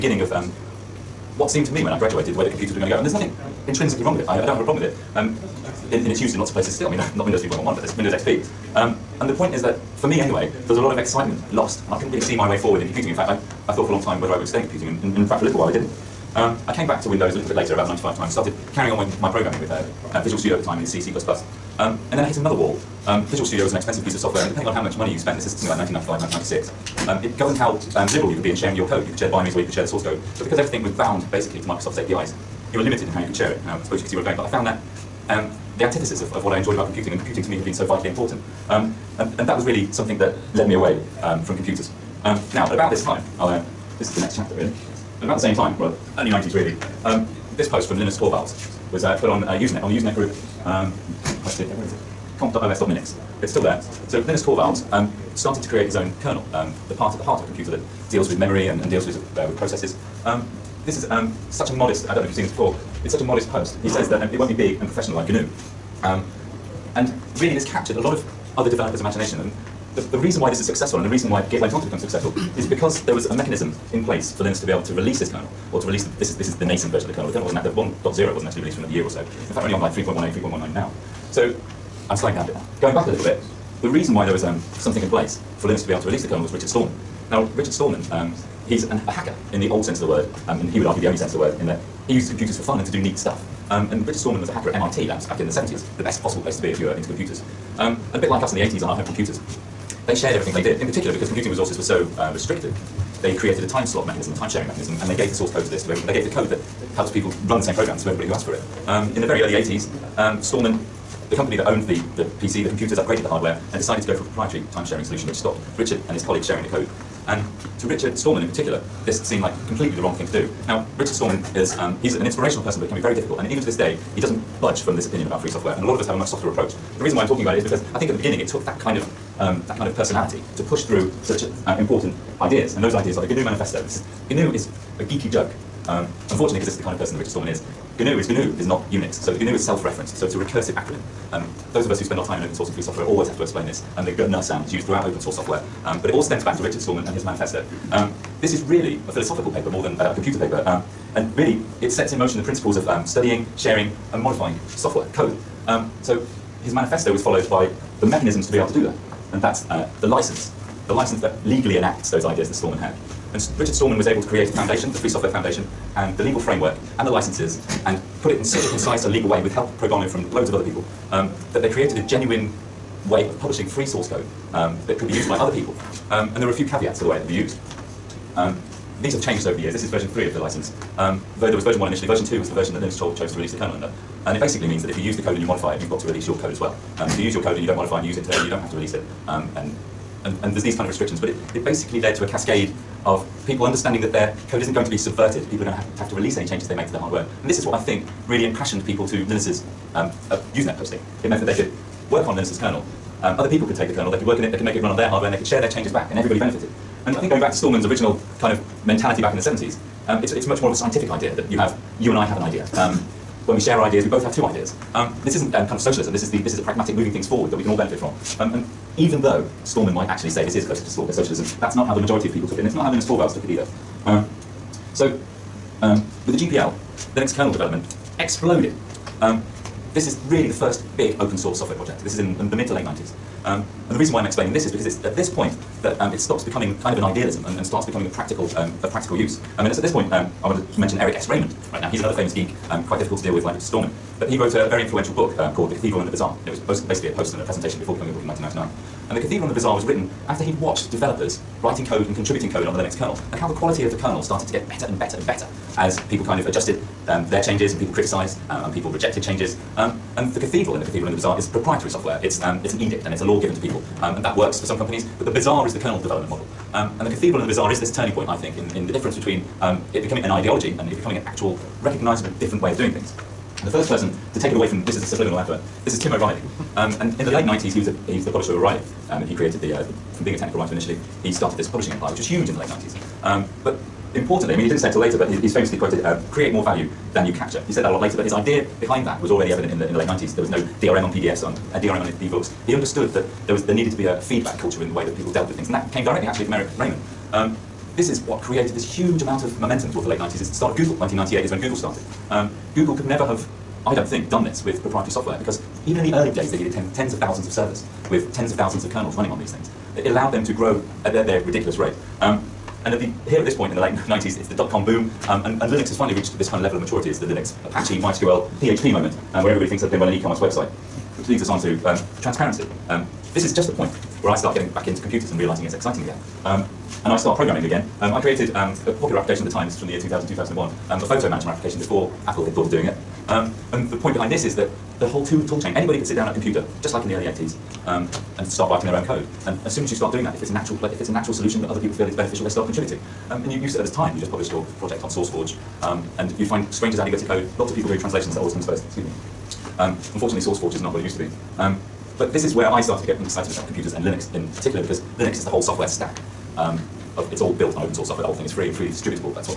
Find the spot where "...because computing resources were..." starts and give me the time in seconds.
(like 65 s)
101 s.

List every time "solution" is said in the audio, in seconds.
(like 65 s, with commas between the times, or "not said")
115 s, 341 s.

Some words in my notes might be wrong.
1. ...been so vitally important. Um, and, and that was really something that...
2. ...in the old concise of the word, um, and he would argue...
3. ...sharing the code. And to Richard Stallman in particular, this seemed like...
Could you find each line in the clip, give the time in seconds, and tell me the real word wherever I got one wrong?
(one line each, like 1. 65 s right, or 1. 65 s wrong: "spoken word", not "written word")
1. 37 s right
2. 89 s wrong: "sense", not "concise"
3. 116 s right.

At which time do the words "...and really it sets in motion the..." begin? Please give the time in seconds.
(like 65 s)
151 s.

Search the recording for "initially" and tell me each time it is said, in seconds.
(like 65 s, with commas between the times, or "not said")
181 s, 280 s.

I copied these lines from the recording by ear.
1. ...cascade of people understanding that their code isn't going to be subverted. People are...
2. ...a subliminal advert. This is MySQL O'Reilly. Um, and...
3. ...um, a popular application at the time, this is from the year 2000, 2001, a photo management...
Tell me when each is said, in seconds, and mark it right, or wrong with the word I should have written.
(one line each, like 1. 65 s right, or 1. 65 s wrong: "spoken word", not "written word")
1. 192 s right
2. 275 s wrong: "Tim", not "MySQL"
3. 328 s right.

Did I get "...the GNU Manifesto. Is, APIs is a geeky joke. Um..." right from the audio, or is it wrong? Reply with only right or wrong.
wrong.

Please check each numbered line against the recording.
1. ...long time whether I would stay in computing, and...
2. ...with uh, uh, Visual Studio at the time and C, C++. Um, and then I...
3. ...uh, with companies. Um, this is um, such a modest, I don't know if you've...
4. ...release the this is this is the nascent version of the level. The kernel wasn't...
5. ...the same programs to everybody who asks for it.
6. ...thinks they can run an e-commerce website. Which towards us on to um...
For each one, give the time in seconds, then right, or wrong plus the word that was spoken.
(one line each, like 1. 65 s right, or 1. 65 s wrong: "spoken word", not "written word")
1. 13 s right
2. 19 s right
3. 59 s wrong: "processes", not "companies"
4. 75 s wrong: "kernel", not "level"
5. 107 s right
6. 319 s wrong: "leads", not "towards".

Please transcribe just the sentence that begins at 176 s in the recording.
Um, and there are a few caveats to the way it could be used.